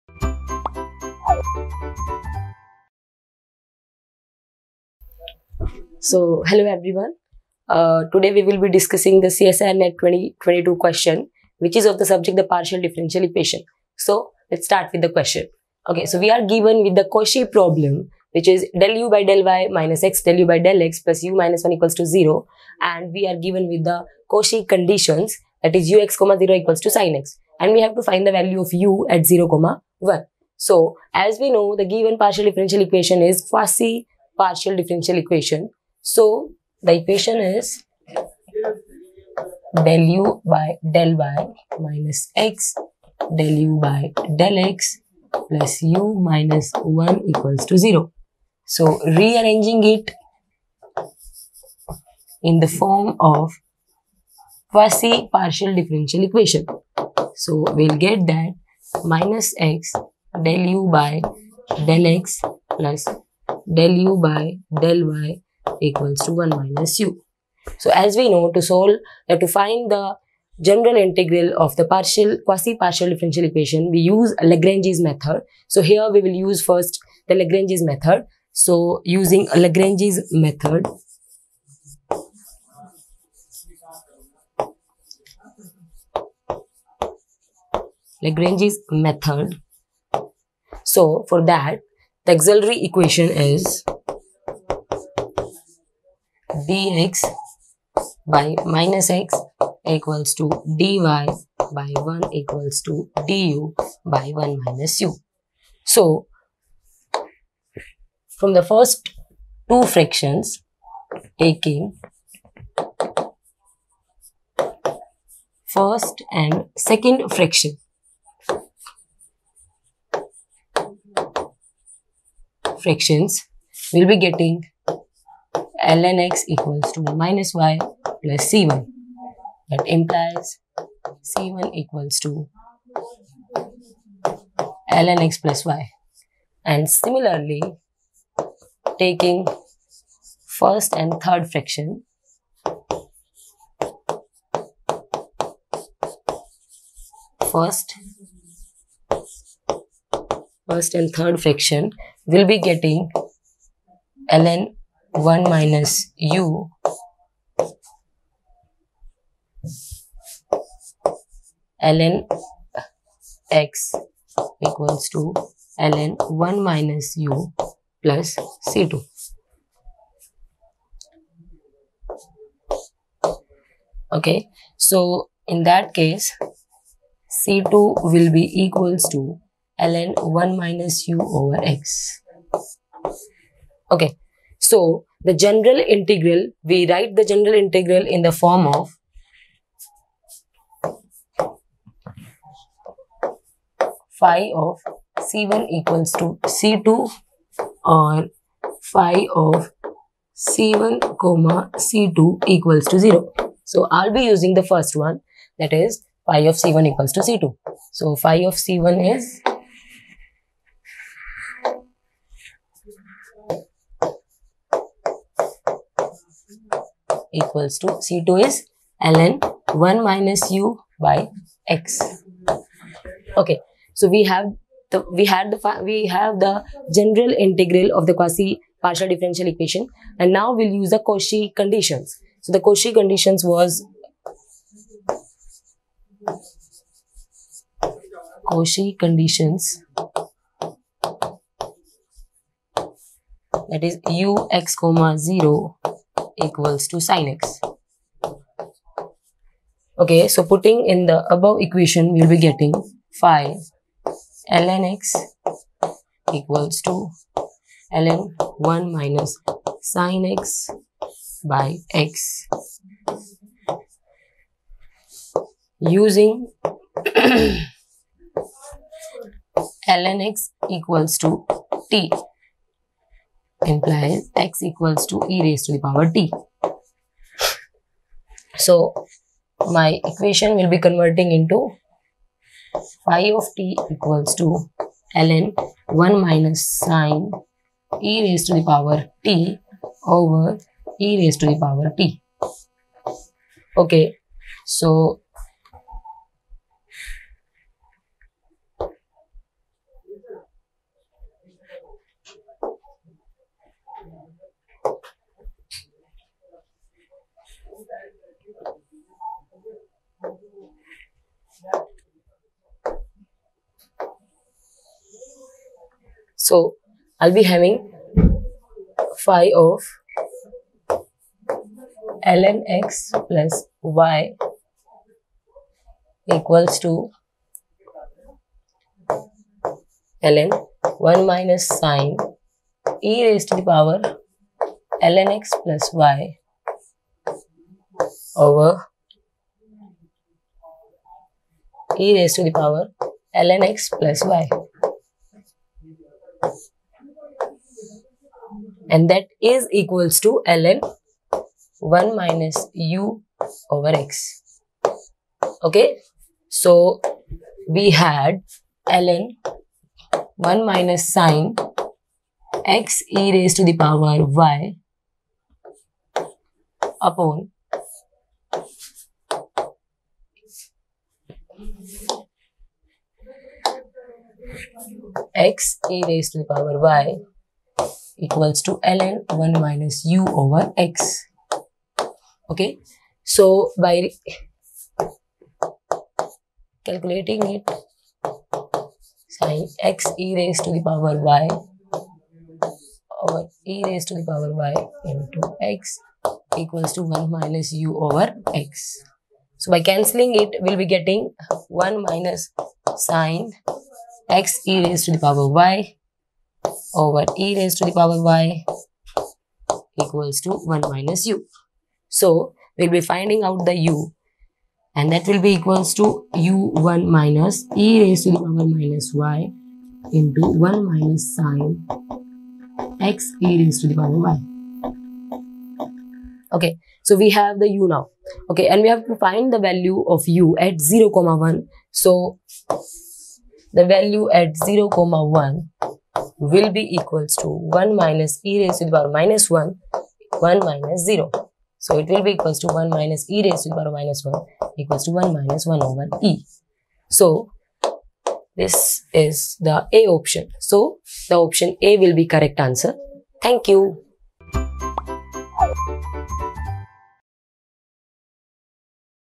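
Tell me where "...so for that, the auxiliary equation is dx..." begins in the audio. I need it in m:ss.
1:30.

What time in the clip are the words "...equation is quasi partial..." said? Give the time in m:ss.
0:32.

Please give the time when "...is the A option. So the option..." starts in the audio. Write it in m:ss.
7:29.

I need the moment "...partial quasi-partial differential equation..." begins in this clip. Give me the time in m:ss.
1:11.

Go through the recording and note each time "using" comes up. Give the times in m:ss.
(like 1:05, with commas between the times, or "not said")
1:19, 3:24, 4:25.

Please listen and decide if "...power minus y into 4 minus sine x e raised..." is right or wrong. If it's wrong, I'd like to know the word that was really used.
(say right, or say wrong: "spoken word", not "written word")
wrong: "1", not "4".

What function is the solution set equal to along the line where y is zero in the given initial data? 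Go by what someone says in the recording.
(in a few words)
sin x.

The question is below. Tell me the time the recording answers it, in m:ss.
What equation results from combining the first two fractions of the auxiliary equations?
2:05.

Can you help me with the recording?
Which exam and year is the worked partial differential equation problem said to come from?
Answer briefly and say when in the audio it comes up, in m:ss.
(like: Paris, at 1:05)
CSIR NET 2022, at 0:09.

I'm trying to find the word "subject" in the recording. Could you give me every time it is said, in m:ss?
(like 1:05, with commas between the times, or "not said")
0:12.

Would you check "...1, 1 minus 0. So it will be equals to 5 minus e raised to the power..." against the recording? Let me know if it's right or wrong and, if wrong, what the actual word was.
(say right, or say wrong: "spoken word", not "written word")
wrong: "1", not "5".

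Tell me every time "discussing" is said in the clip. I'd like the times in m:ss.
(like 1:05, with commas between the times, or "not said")
0:08.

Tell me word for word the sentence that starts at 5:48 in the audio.
and that is equals to ln 1 minus u over x.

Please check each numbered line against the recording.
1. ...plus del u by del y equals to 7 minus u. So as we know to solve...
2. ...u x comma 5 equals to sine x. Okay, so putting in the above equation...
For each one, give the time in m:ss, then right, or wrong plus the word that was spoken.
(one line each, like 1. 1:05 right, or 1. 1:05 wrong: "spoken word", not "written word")
1. 1:02 wrong: "1", not "7"
2. 4:04 wrong: "0", not "5".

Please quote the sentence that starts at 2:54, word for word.
Okay, so in that case, c2 will be equals to ln 1 minus u over x.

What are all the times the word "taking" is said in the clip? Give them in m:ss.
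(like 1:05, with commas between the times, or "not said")
1:51, 2:18.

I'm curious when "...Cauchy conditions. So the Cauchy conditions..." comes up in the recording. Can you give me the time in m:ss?
3:50.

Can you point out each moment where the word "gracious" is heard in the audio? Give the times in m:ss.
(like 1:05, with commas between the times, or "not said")
not said.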